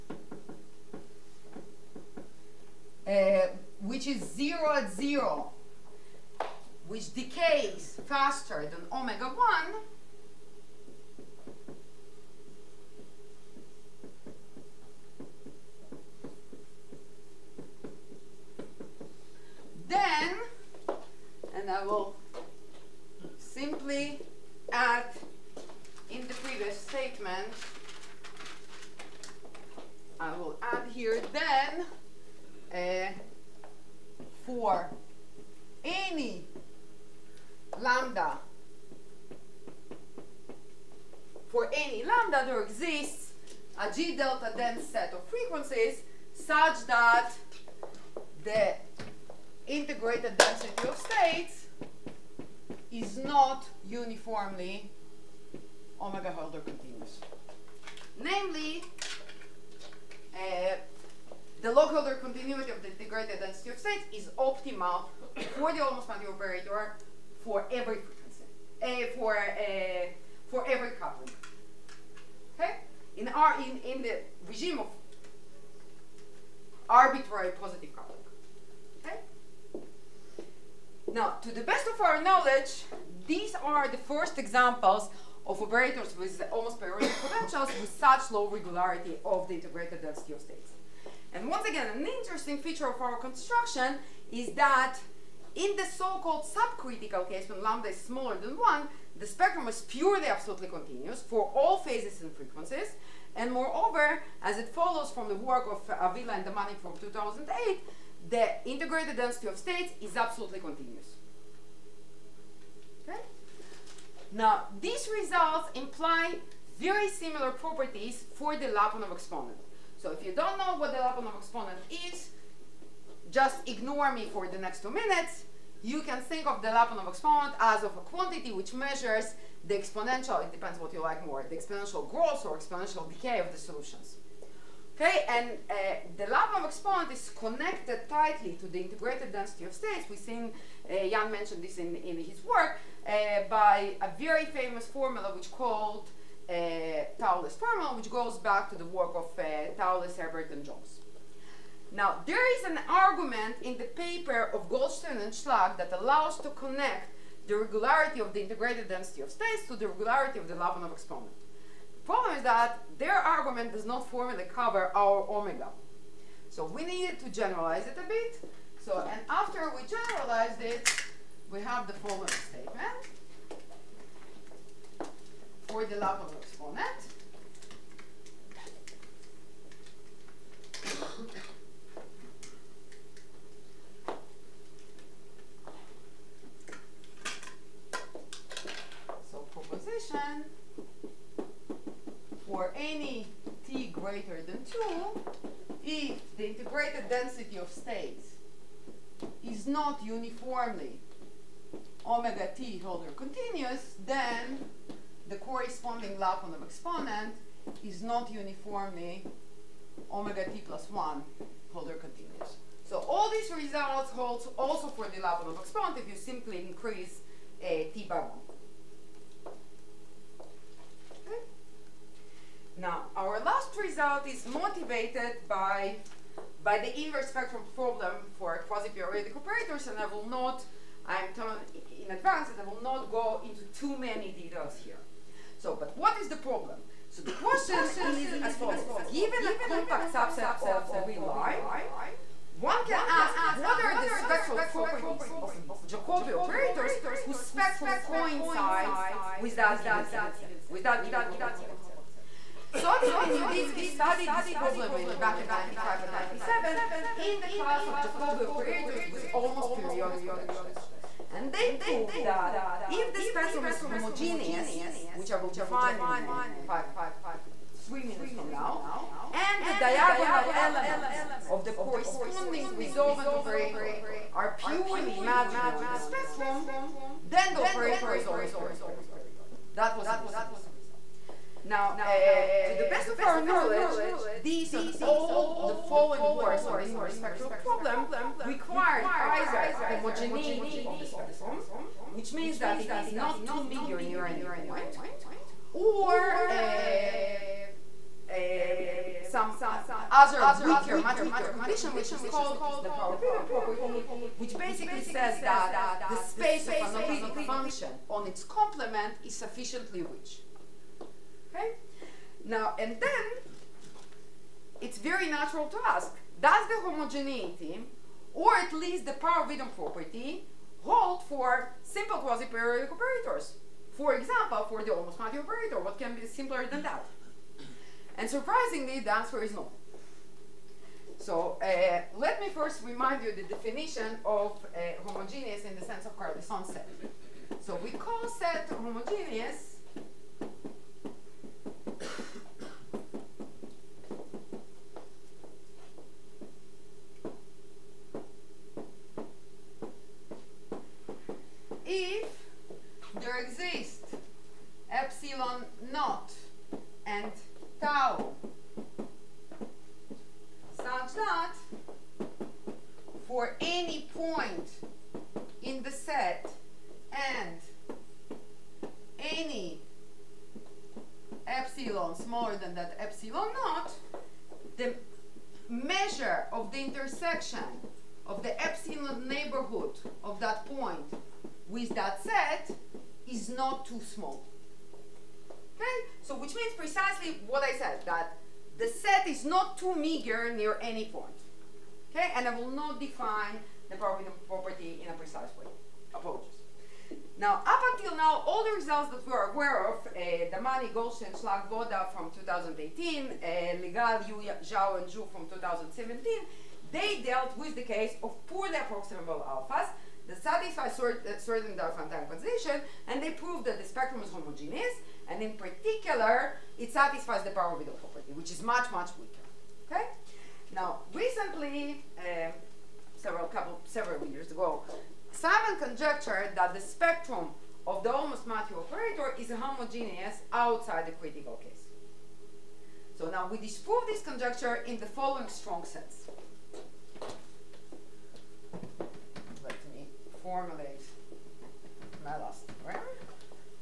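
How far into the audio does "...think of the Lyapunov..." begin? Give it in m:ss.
2:06.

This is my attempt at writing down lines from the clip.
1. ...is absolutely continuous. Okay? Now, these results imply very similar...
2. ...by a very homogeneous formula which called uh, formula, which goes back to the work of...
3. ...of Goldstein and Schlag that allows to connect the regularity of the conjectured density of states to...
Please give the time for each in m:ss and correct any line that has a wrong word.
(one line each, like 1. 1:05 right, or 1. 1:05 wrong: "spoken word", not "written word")
1. 1:50 right
2. 2:23 wrong: "famous", not "homogeneous"
3. 2:34 wrong: "integrated", not "conjectured".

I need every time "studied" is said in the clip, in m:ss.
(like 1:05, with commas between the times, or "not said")
4:13.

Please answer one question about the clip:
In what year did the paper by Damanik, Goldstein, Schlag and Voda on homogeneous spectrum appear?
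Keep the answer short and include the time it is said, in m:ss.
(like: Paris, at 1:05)
2018, at 6:42.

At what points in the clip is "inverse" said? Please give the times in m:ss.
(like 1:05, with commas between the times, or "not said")
3:47, 4:46.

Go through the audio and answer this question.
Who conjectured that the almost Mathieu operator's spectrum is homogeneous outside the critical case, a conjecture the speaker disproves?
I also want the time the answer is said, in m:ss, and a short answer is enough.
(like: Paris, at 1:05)
Simon, at 7:05.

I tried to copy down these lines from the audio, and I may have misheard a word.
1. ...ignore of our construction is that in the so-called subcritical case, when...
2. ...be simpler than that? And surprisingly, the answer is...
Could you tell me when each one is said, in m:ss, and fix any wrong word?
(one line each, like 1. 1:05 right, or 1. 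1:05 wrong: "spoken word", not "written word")
1. 1:32 wrong: "feature", not "ignore"
2. 5:26 right.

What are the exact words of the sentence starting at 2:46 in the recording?
So we needed to generalize it a bit.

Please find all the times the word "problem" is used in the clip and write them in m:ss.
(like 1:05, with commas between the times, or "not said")
2:42, 3:47, 3:56, 4:14, 4:47.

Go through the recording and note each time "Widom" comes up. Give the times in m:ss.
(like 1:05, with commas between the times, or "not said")
5:02, 5:19, 6:57.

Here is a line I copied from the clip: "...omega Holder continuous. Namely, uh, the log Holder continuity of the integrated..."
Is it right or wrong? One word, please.
right.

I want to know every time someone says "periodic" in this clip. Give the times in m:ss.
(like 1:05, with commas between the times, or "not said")
1:26, 3:48, 4:19, 4:38, 5:22.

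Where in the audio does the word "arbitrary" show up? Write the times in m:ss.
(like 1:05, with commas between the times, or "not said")
1:16.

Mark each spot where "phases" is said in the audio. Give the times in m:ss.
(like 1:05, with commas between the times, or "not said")
1:41.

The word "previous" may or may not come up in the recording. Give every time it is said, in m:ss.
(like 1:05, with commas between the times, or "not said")
0:26.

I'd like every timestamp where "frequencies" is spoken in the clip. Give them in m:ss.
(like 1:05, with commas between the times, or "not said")
0:45, 1:42.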